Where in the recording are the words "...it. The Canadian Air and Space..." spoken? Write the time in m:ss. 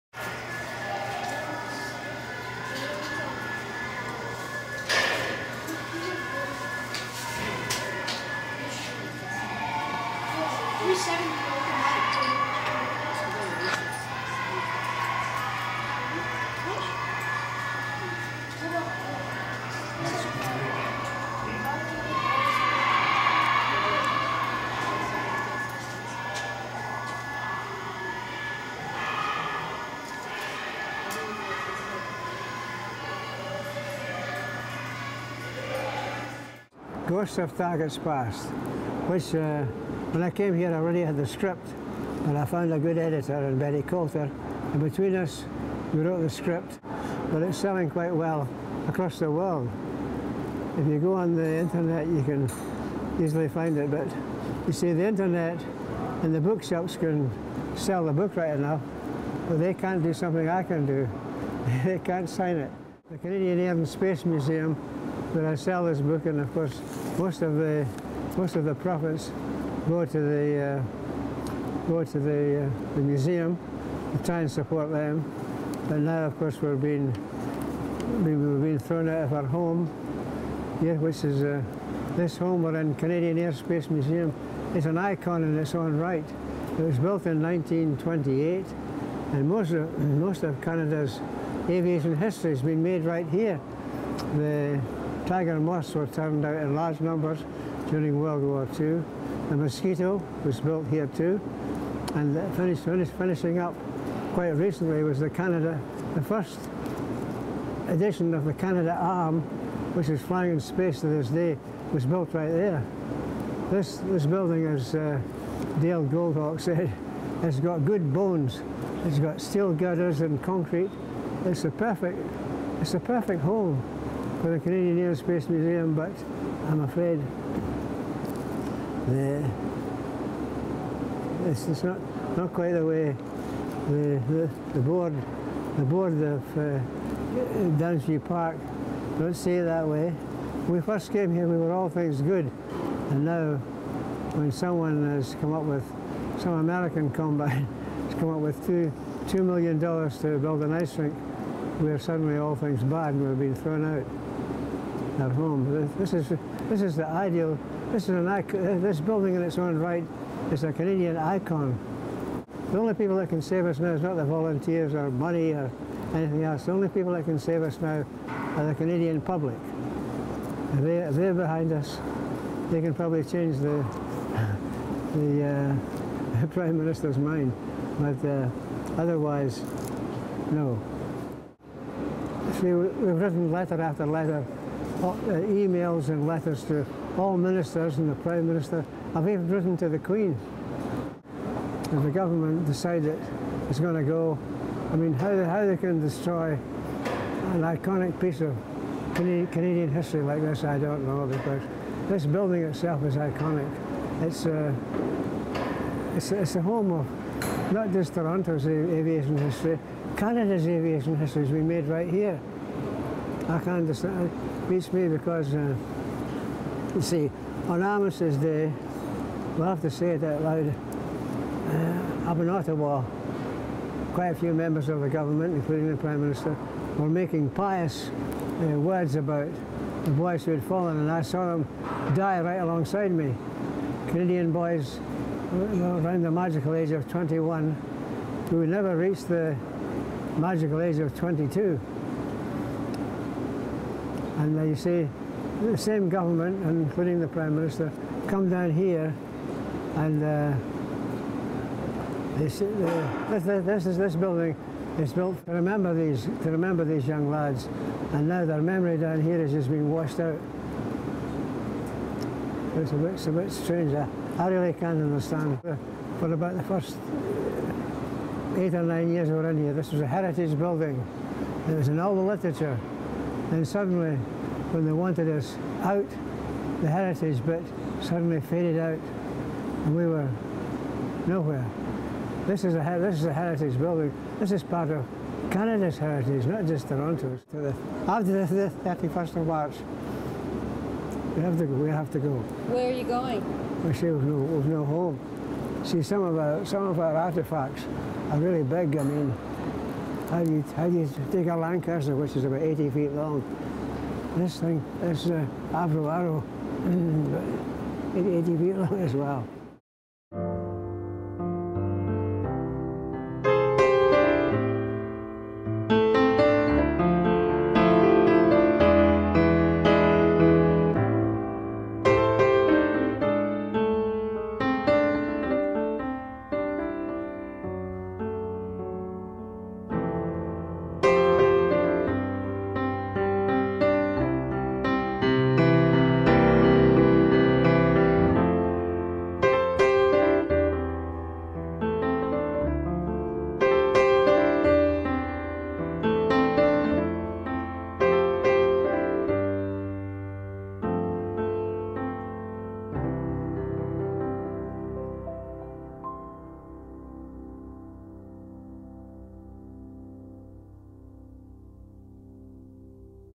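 1:02.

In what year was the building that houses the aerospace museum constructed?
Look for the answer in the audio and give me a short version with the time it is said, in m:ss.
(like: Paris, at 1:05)
1928, at 1:27.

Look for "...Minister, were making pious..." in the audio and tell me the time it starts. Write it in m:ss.
3:46.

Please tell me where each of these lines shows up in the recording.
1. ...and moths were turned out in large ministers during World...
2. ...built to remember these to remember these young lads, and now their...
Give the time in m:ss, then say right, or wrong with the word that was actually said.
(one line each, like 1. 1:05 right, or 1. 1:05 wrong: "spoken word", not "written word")
1. 1:35 wrong: "numbers", not "ministers"
2. 4:15 right.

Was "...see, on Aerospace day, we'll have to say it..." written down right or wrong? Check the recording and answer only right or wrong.
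wrong.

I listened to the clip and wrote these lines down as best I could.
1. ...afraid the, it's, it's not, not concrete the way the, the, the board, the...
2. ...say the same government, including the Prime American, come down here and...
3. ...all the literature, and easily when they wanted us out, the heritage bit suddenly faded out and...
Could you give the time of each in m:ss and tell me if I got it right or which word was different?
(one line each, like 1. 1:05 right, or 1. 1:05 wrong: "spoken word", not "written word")
1. 2:06 wrong: "quite", not "concrete"
2. 4:04 wrong: "Minister", not "American"
3. 4:31 wrong: "suddenly", not "easily".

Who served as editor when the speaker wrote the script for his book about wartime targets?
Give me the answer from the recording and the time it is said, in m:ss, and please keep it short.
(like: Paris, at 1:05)
Betty Coulter, at 0:43.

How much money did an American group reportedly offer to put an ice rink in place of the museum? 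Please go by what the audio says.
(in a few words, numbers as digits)
$2 million.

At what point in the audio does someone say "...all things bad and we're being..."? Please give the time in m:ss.
2:32.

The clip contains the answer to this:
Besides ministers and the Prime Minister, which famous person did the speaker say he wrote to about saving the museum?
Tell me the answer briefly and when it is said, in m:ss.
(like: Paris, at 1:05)
the Queen, at 3:09.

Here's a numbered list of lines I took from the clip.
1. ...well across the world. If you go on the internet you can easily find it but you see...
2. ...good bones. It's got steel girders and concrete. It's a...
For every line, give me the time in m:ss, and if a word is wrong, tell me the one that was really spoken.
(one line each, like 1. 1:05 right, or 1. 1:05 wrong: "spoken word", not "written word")
1. 0:48 right
2. 1:57 right.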